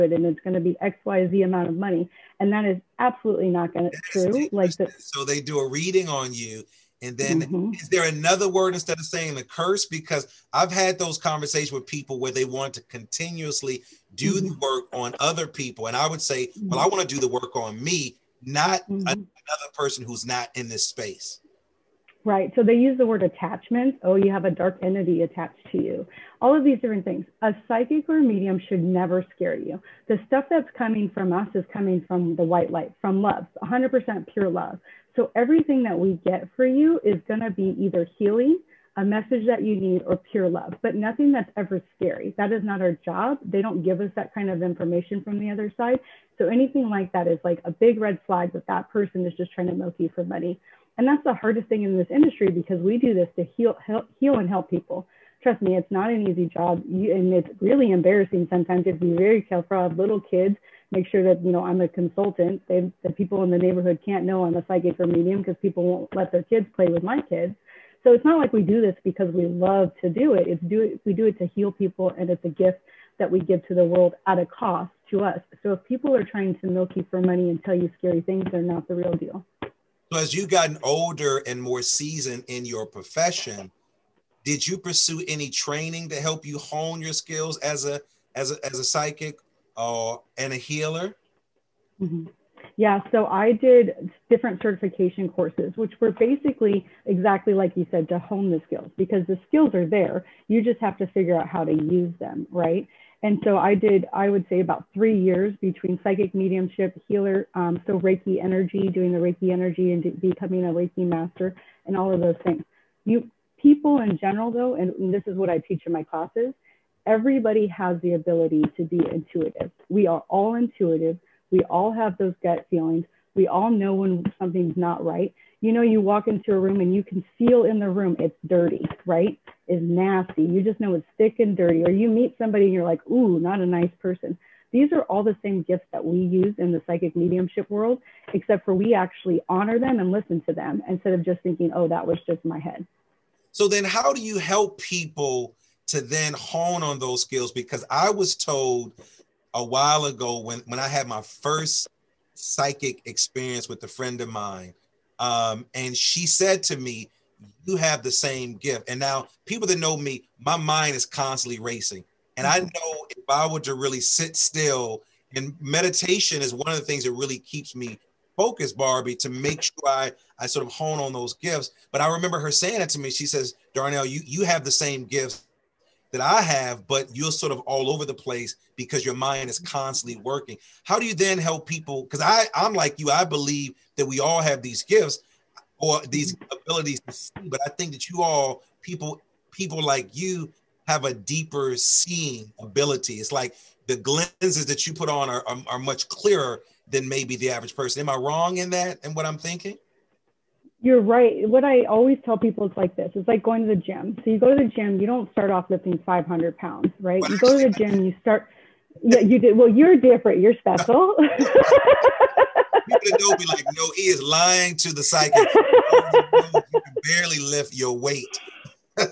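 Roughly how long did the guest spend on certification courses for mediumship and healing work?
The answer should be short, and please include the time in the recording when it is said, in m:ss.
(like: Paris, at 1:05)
3 years, at 1:44.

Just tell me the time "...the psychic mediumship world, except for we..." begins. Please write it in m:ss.
2:16.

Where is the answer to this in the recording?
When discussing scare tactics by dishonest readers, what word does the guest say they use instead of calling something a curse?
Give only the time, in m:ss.
0:23.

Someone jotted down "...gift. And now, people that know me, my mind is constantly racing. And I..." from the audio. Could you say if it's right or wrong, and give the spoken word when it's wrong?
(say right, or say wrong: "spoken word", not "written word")
right.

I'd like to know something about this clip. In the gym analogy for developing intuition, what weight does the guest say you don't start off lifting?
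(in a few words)
500 pounds.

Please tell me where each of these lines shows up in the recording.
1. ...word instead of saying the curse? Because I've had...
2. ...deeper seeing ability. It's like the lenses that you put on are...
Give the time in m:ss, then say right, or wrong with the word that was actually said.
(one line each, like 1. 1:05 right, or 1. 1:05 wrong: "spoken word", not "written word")
1. 0:08 right
2. 3:11 right.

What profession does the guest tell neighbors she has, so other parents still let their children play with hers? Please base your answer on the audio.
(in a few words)
consultant.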